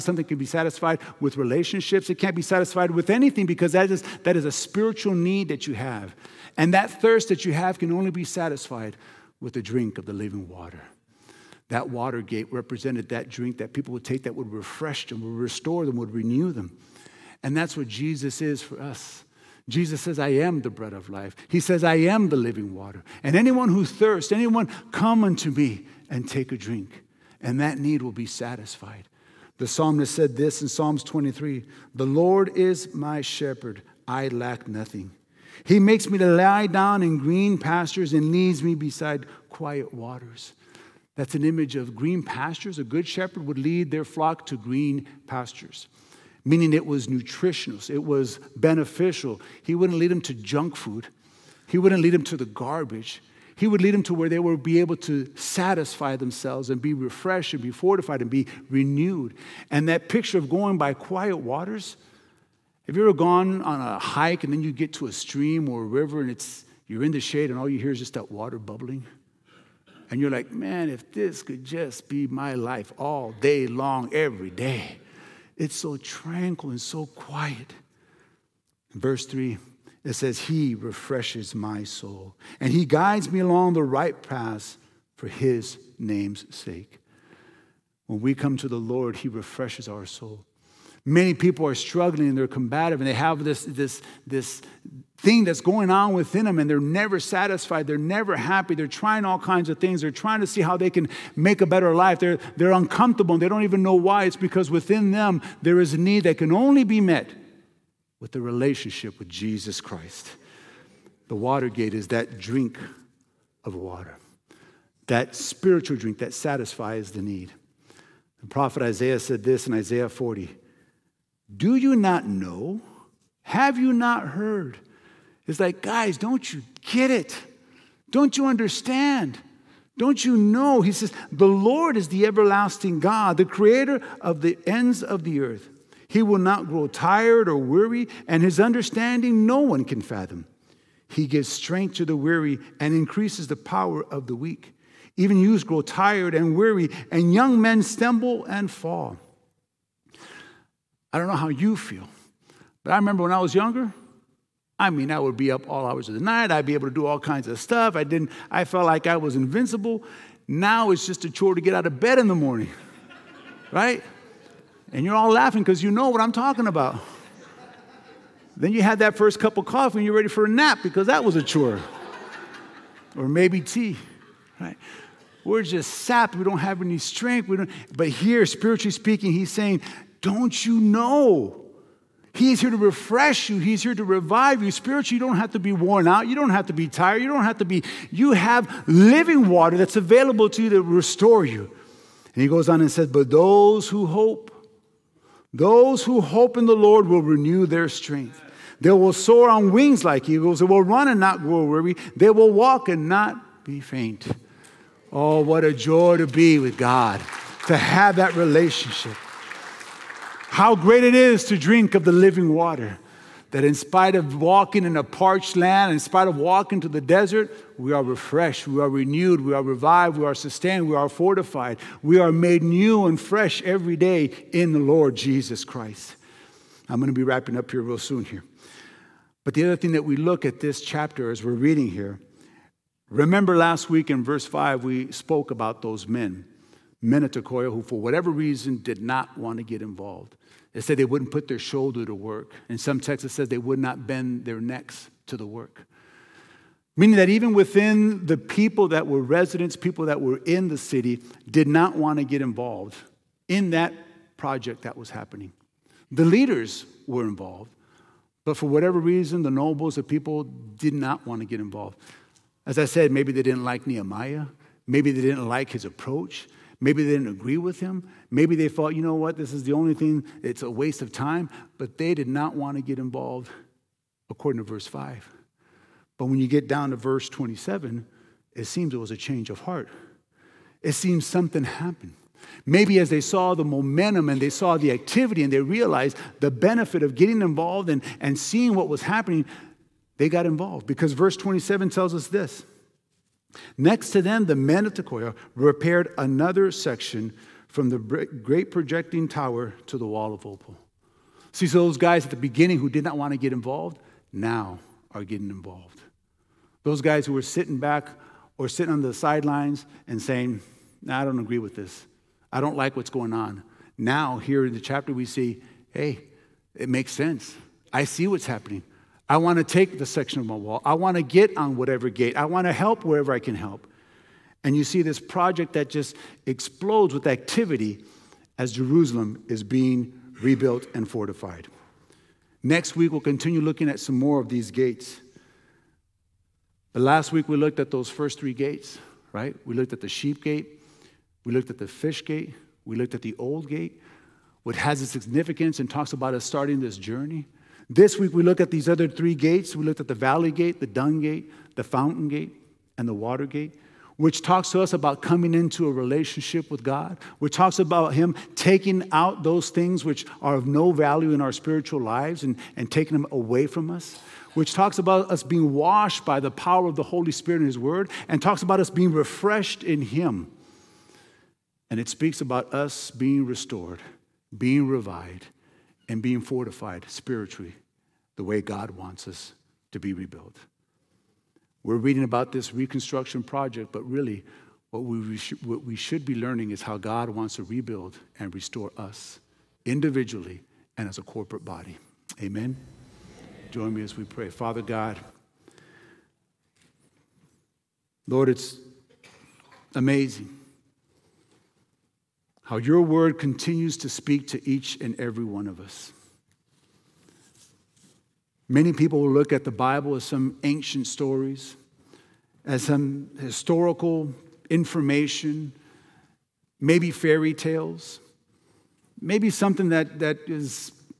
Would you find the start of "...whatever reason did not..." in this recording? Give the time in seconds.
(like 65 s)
237 s.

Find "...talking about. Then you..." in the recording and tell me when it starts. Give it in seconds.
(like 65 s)
166 s.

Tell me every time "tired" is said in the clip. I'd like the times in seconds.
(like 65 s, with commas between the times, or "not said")
136 s, 145 s, 186 s.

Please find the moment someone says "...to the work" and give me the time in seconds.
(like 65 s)
245 s.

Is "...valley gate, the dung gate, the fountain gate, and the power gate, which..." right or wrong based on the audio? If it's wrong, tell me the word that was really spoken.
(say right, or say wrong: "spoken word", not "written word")
wrong: "water", not "power".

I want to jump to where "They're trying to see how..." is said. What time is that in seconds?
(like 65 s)
100 s.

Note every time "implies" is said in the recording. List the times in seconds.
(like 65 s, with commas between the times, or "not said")
not said.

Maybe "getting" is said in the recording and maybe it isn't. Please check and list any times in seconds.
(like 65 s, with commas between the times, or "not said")
287 s, 305 s.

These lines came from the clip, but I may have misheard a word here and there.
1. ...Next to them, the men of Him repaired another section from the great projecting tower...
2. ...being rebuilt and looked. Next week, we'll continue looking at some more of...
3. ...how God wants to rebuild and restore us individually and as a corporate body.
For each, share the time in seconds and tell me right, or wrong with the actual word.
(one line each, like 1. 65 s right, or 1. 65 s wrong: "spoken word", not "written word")
1. 293 s wrong: "Tekoa", not "Him"
2. 329 s wrong: "fortified", not "looked"
3. 386 s right.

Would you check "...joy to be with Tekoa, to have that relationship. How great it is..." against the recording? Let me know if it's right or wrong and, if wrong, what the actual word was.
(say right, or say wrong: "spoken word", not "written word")
wrong: "God", not "Tekoa".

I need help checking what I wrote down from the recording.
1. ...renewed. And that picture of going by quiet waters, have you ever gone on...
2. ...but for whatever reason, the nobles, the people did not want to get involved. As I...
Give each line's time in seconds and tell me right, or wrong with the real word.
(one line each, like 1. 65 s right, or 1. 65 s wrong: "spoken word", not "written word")
1. 58 s right
2. 258 s right.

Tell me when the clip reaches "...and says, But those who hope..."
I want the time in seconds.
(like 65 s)
192 s.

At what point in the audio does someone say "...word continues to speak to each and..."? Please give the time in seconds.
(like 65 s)
402 s.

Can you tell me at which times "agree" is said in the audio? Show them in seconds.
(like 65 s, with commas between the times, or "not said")
267 s, 311 s.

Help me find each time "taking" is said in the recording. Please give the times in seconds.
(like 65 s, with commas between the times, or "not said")
358 s, 362 s.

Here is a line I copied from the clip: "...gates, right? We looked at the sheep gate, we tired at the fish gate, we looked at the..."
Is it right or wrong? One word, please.
wrong.